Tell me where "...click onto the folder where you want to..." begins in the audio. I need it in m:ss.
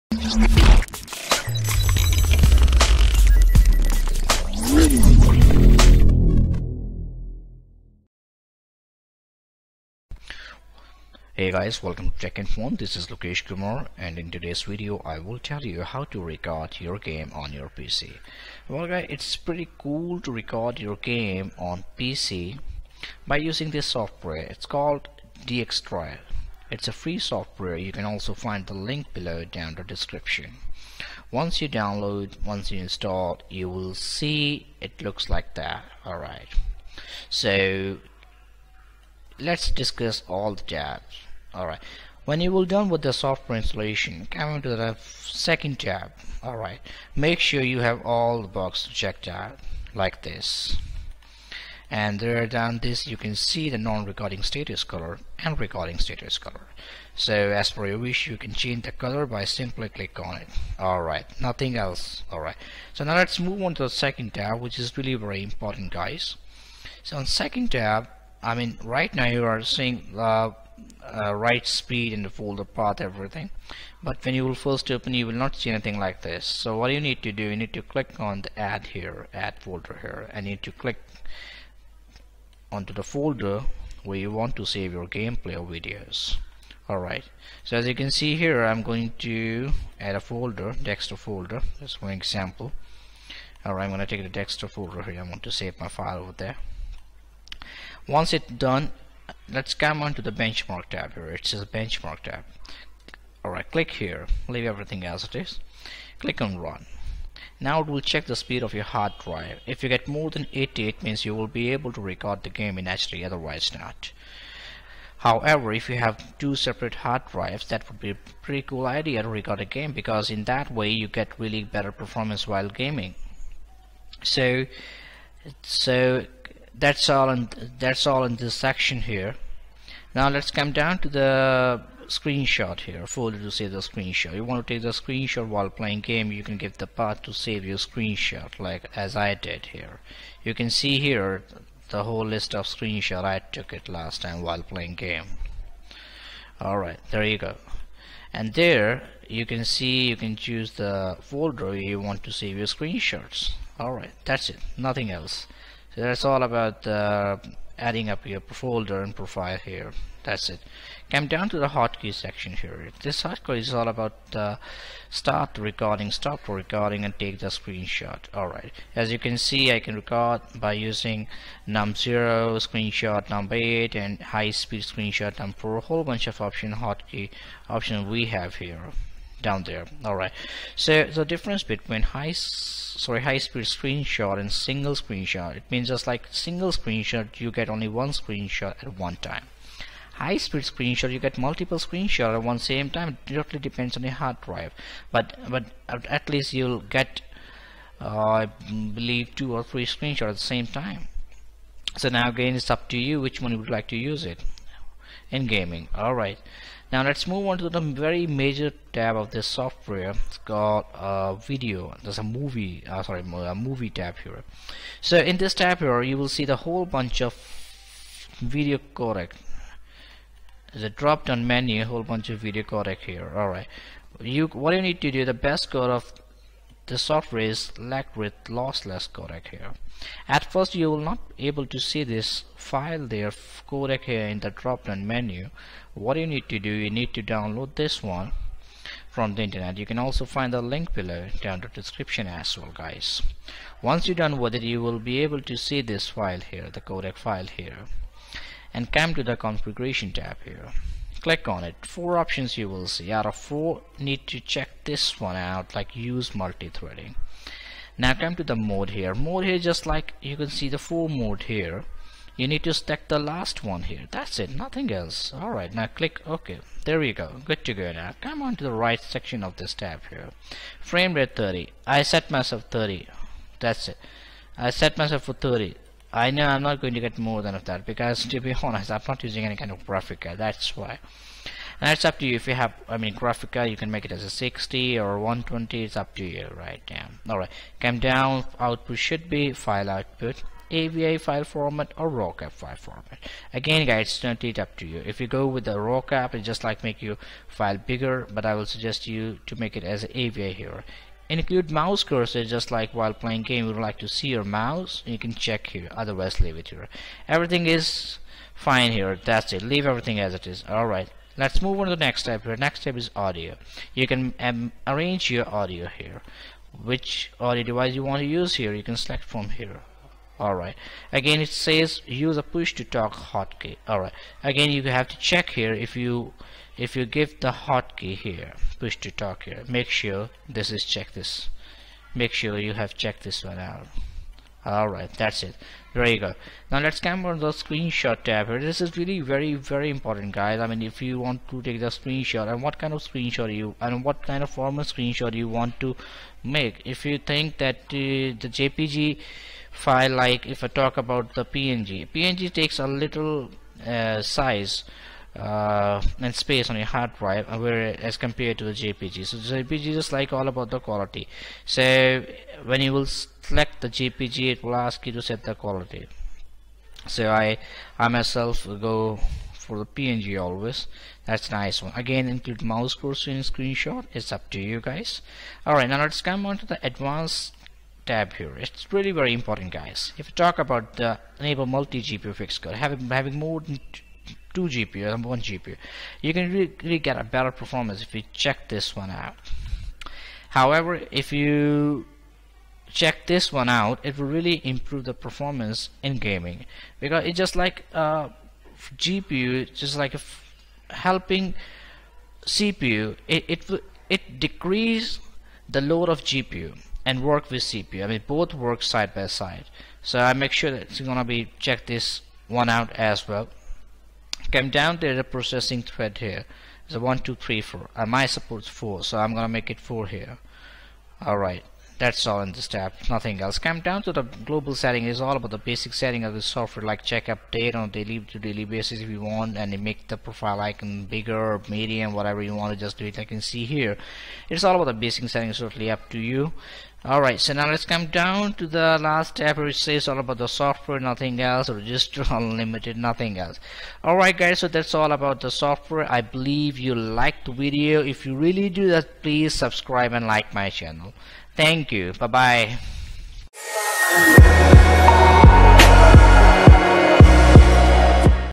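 1:20.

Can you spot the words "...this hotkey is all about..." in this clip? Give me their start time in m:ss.
2:43.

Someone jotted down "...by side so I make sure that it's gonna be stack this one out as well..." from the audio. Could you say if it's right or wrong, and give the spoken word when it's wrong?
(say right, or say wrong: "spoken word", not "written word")
wrong: "check", not "stack".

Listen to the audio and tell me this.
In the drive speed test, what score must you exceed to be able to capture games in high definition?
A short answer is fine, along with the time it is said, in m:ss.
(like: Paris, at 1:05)
80, at 1:50.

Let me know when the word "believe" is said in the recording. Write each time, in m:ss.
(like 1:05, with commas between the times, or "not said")
3:18, 7:26.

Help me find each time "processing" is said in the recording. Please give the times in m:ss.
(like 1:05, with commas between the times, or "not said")
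6:55.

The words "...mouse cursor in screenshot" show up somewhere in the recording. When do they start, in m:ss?
6:12.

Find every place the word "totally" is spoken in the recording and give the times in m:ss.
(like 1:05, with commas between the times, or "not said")
4:54, 7:15.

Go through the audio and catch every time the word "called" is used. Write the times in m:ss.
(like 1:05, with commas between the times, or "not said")
0:24, 3:30.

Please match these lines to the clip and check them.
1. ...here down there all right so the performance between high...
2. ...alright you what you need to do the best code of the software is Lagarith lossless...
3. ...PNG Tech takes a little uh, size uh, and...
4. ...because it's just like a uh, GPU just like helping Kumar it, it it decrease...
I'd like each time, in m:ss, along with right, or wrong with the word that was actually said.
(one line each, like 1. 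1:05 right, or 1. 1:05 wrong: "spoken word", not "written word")
1. 2:58 wrong: "difference", not "performance"
2. 3:43 right
3. 5:51 wrong: "PNG", not "Tech"
4. 6:36 wrong: "CPU", not "Kumar".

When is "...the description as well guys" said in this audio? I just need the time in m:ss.
4:01.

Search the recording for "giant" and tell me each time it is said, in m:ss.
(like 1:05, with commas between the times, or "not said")
not said.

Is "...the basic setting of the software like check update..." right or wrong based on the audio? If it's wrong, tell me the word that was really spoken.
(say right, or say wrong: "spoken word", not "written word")
right.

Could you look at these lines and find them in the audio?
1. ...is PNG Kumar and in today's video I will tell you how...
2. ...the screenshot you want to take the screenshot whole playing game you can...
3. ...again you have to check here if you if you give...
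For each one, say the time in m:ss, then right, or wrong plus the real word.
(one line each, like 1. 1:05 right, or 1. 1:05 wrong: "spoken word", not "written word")
1. 0:12 wrong: "Lokesh", not "PNG"
2. 2:13 wrong: "while", not "whole"
3. 5:24 right.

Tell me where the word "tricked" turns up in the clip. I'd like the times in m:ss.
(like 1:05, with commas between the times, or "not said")
not said.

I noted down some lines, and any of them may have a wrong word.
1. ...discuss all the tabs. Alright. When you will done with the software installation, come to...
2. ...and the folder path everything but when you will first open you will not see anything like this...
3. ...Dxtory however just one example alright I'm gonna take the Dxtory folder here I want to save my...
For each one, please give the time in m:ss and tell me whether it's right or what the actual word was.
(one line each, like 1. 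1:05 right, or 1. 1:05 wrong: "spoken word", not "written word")
1. 0:39 right
2. 1:12 right
3. 1:30 wrong: "folder", not "however".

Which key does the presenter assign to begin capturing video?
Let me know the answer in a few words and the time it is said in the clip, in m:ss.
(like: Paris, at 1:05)
num0, at 2:51.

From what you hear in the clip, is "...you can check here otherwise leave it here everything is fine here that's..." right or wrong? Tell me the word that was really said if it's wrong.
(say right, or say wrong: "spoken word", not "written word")
right.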